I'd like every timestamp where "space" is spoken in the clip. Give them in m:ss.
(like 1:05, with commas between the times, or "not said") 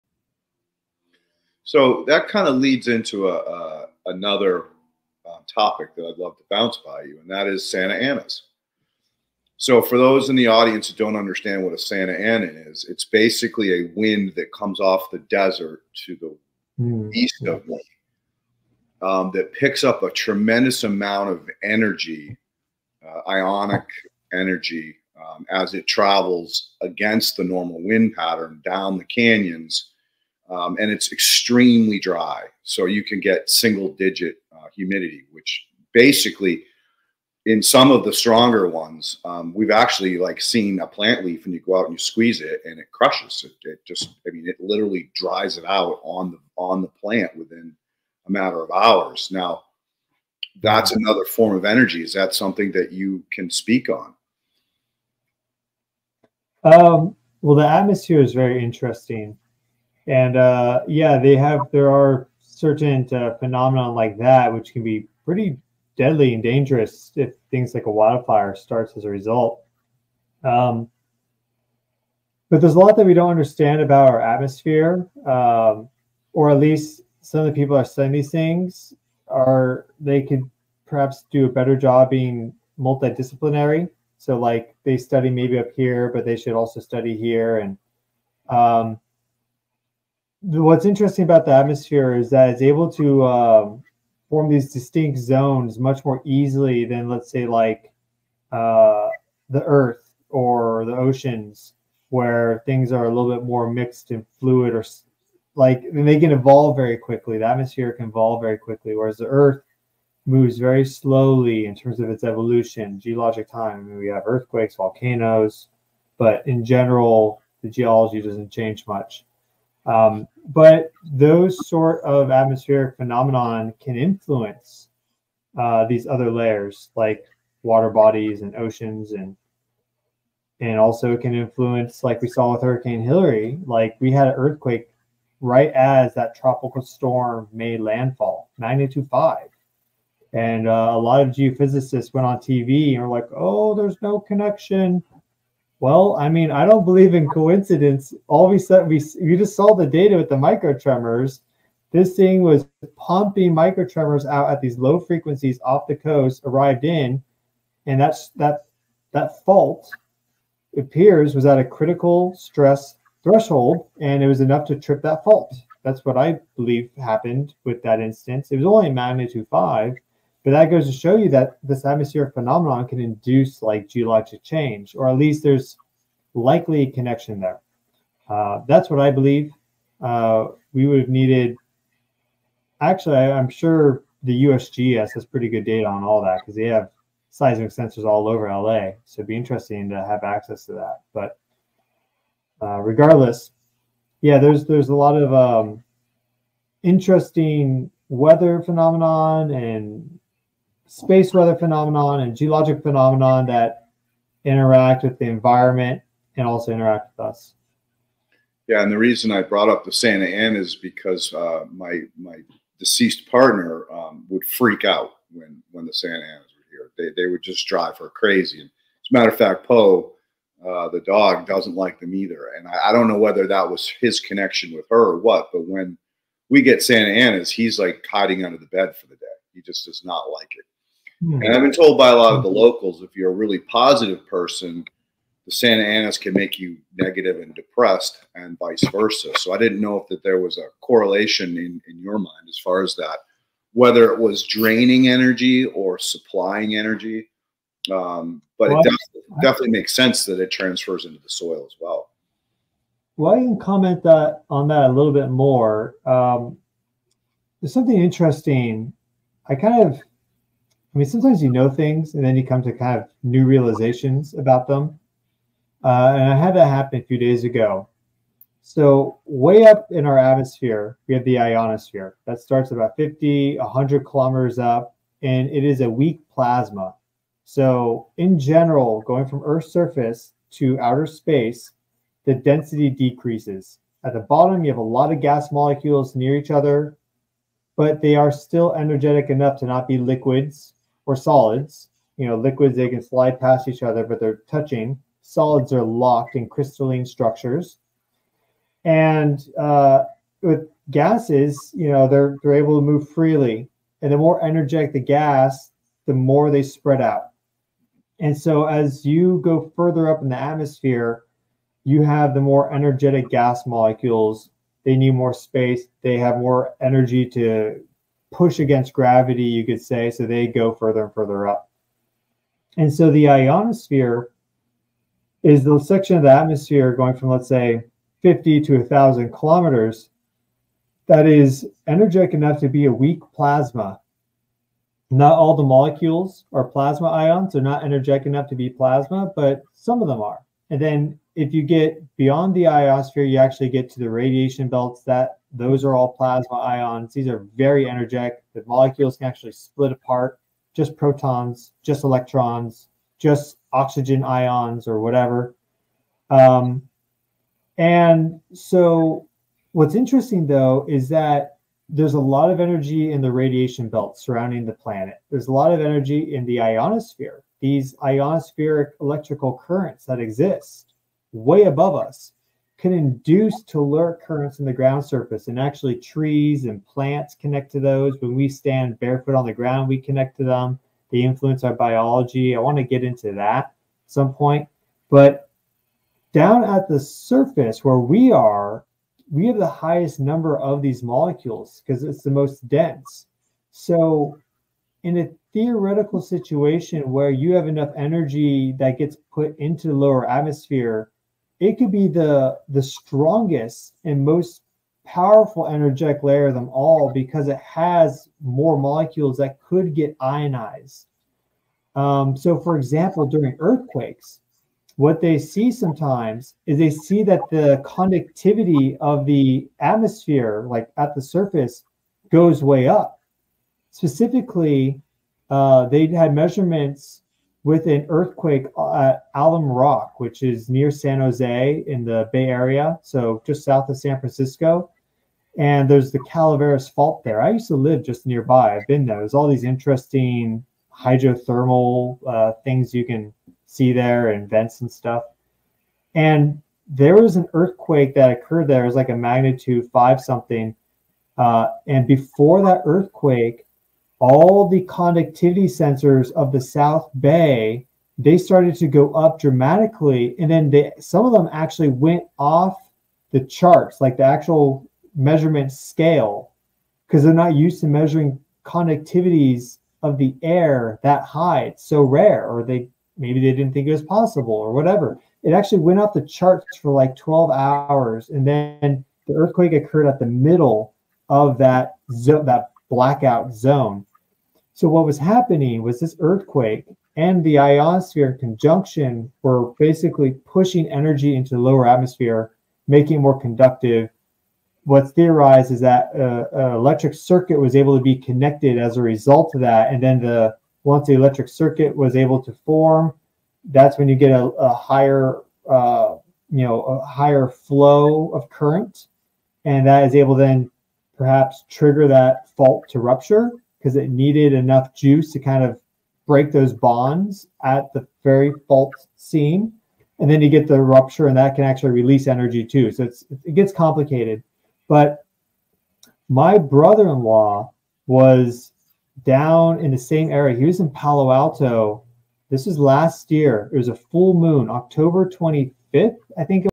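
3:20, 4:41, 5:15.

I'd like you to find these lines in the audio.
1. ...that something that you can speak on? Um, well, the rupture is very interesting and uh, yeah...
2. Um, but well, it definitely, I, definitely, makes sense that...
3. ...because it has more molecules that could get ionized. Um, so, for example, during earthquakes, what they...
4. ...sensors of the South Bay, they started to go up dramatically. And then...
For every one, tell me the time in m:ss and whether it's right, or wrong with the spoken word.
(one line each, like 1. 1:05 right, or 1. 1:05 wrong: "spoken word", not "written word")
1. 0:52 wrong: "atmosphere", not "rupture"
2. 4:07 right
3. 6:47 right
4. 7:35 right.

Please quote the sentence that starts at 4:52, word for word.
You know, liquids, they can slide past each other, but they're touching.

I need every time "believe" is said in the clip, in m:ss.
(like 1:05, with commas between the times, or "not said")
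2:26, 2:46, 2:59.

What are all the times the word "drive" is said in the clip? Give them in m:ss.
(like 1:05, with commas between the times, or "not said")
3:37.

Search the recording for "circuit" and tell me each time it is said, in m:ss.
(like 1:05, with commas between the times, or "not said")
8:17, 8:21.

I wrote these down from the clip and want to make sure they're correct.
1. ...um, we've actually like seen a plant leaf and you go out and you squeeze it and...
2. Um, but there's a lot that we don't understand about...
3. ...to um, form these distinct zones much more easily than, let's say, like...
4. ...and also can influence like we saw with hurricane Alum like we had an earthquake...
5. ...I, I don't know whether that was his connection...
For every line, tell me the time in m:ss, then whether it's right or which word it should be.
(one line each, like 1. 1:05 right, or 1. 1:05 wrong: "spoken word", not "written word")
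1. 0:39 right
2. 1:10 right
3. 1:32 right
4. 2:10 wrong: "Hilary", not "Alum"
5. 3:42 right.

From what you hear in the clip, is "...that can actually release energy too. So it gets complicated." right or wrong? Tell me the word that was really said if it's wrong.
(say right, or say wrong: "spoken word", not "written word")
right.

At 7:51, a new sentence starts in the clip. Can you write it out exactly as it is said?
It's so rare, or they maybe they didn't think it was possible, or whatever.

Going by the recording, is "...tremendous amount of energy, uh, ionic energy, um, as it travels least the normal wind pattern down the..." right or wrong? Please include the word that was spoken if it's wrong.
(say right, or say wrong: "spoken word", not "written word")
wrong: "against", not "least".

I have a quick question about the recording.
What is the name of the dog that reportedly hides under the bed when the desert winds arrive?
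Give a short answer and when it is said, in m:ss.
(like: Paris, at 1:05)
Poe, at 3:39.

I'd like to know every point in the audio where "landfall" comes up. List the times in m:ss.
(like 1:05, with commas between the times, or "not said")
2:17.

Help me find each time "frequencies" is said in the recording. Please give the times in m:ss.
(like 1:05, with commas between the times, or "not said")
2:34.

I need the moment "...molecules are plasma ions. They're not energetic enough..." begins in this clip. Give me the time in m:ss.
5:35.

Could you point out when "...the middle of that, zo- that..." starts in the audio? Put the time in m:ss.
8:00.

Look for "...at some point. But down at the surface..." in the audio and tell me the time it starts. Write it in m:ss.
6:23.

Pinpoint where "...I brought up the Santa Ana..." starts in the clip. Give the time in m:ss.
3:29.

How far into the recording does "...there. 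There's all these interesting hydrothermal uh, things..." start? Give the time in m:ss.
7:19.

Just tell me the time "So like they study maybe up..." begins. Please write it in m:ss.
1:24.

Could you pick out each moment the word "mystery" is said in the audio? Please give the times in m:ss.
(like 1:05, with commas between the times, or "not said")
not said.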